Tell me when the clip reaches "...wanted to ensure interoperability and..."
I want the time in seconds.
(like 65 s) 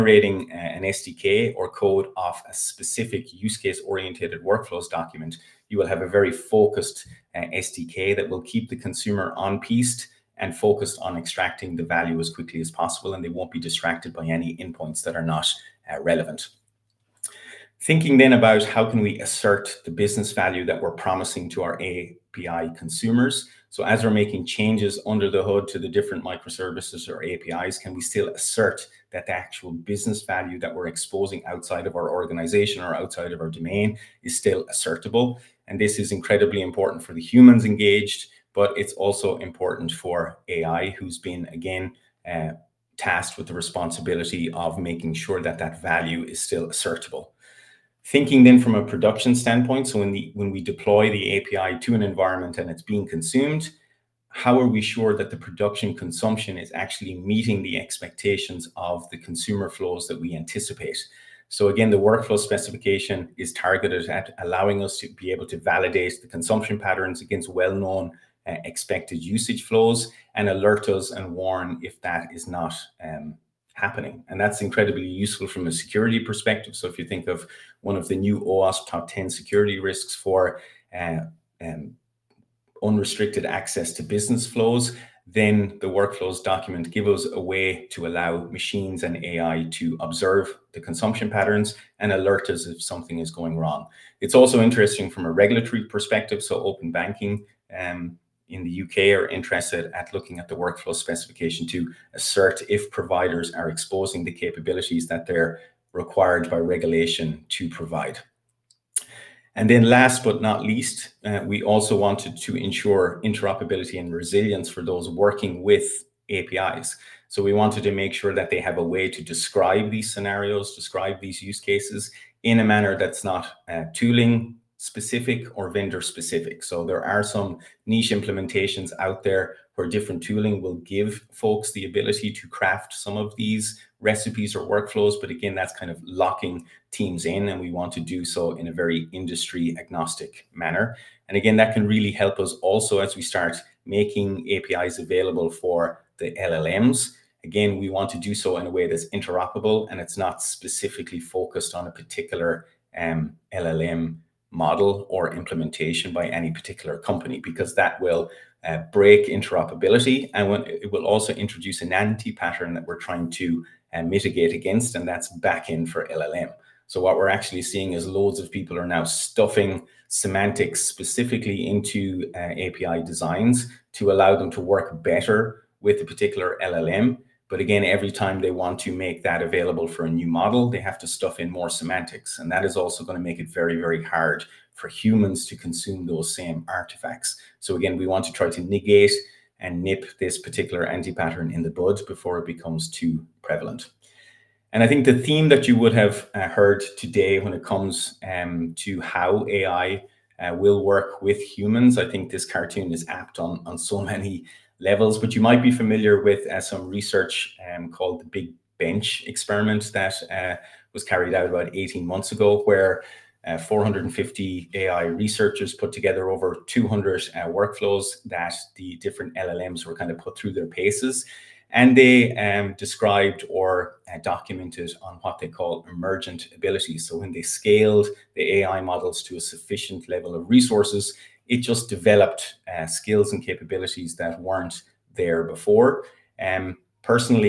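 111 s.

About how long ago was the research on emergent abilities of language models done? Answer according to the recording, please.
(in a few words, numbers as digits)
18 months.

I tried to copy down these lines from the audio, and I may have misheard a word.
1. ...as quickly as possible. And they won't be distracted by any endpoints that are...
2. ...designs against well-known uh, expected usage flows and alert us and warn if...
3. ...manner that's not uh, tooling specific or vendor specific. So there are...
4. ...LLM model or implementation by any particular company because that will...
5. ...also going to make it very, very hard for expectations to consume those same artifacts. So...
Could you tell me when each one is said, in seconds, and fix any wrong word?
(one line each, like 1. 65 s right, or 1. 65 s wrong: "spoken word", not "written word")
1. 12 s right
2. 66 s wrong: "patterns", not "designs"
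3. 122 s right
4. 153 s right
5. 182 s wrong: "humans", not "expectations".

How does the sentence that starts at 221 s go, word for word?
And they um, described or uh, documented on what they call emergent abilities.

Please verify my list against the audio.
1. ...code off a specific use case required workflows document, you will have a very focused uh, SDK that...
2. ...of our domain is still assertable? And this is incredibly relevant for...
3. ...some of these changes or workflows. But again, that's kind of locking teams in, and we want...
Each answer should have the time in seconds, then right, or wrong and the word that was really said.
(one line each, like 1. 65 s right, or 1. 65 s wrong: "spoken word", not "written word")
1. 1 s wrong: "oriented", not "required"
2. 33 s wrong: "important", not "relevant"
3. 132 s wrong: "recipes", not "changes".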